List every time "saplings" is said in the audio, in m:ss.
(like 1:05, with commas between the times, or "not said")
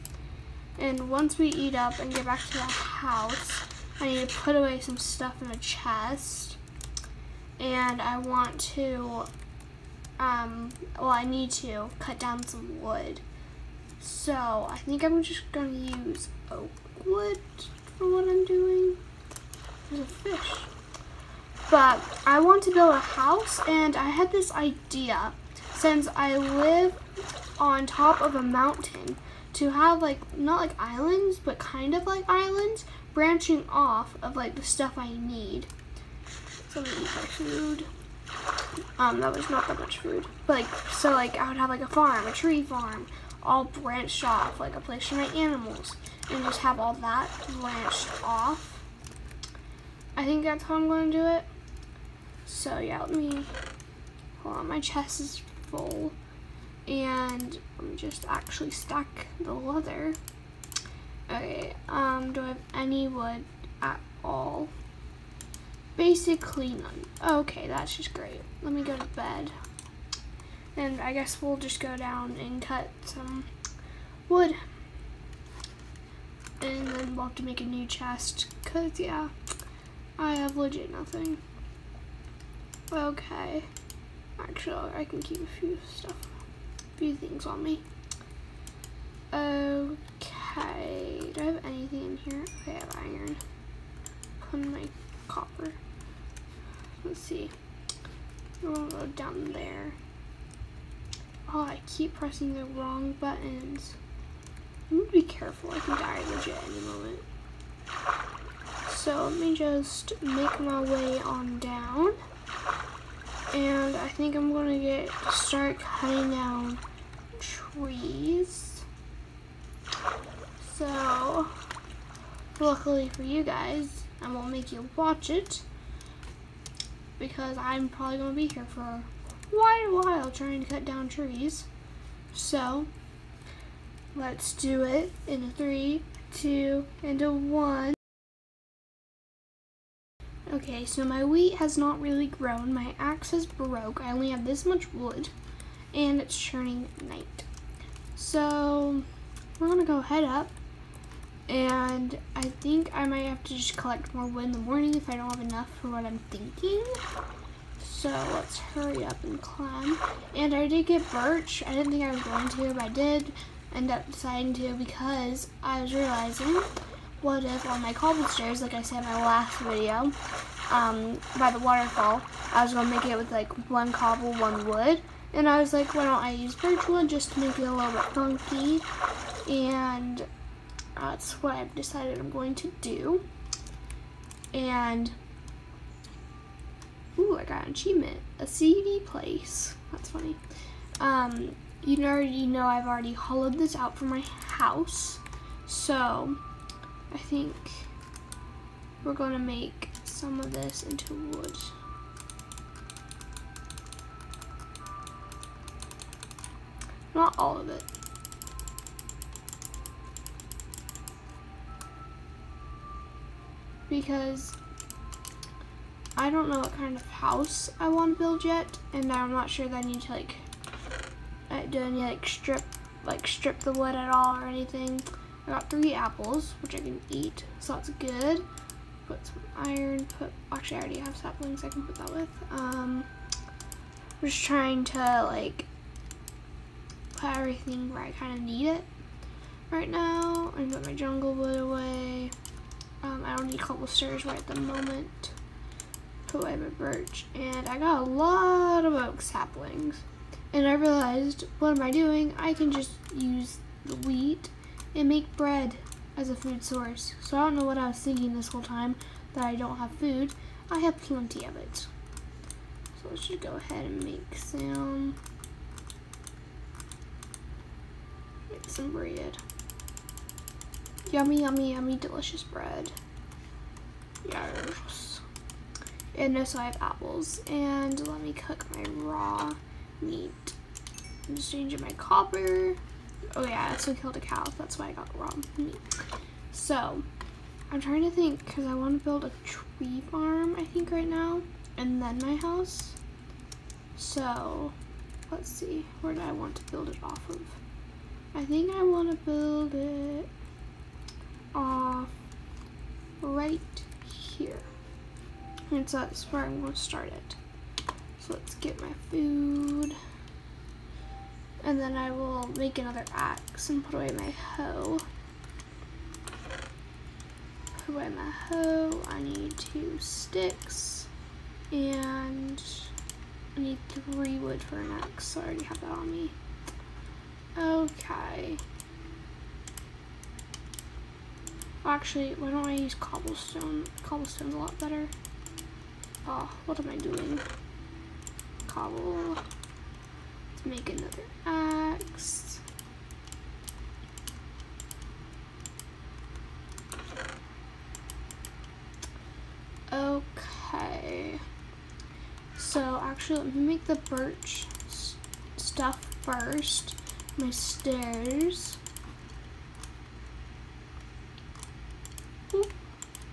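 3:51, 4:09.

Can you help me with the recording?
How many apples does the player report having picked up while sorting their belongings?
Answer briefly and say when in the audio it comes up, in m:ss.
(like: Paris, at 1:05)
3, at 3:45.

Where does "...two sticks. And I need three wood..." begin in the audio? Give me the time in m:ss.
5:19.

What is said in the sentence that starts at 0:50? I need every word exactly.
I think that's how I'm going to do it.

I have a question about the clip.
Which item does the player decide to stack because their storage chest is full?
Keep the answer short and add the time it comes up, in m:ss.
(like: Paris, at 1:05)
Leather, at 0:59.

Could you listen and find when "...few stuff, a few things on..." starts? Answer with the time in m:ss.
1:25.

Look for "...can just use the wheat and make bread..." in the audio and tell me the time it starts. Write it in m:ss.
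4:12.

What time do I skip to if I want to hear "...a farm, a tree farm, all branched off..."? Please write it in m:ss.
0:41.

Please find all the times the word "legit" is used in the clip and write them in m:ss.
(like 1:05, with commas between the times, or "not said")
1:20, 1:46.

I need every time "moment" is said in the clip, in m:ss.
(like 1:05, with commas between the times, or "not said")
1:46, 4:04.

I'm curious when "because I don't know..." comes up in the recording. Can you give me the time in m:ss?
3:33.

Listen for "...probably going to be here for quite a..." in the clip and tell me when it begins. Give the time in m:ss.
2:07.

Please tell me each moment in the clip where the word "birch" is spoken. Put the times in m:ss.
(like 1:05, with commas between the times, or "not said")
2:41, 2:56, 4:06, 5:54.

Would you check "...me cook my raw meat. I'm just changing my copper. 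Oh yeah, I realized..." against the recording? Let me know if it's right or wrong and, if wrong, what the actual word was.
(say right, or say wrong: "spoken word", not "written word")
wrong: "killed", not "realized".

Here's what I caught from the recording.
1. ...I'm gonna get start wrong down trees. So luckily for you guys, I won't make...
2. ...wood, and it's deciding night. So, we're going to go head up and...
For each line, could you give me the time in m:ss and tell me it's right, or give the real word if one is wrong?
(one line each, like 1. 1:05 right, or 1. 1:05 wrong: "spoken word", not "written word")
1. 1:54 wrong: "cutting", not "wrong"
2. 2:24 wrong: "turning", not "deciding".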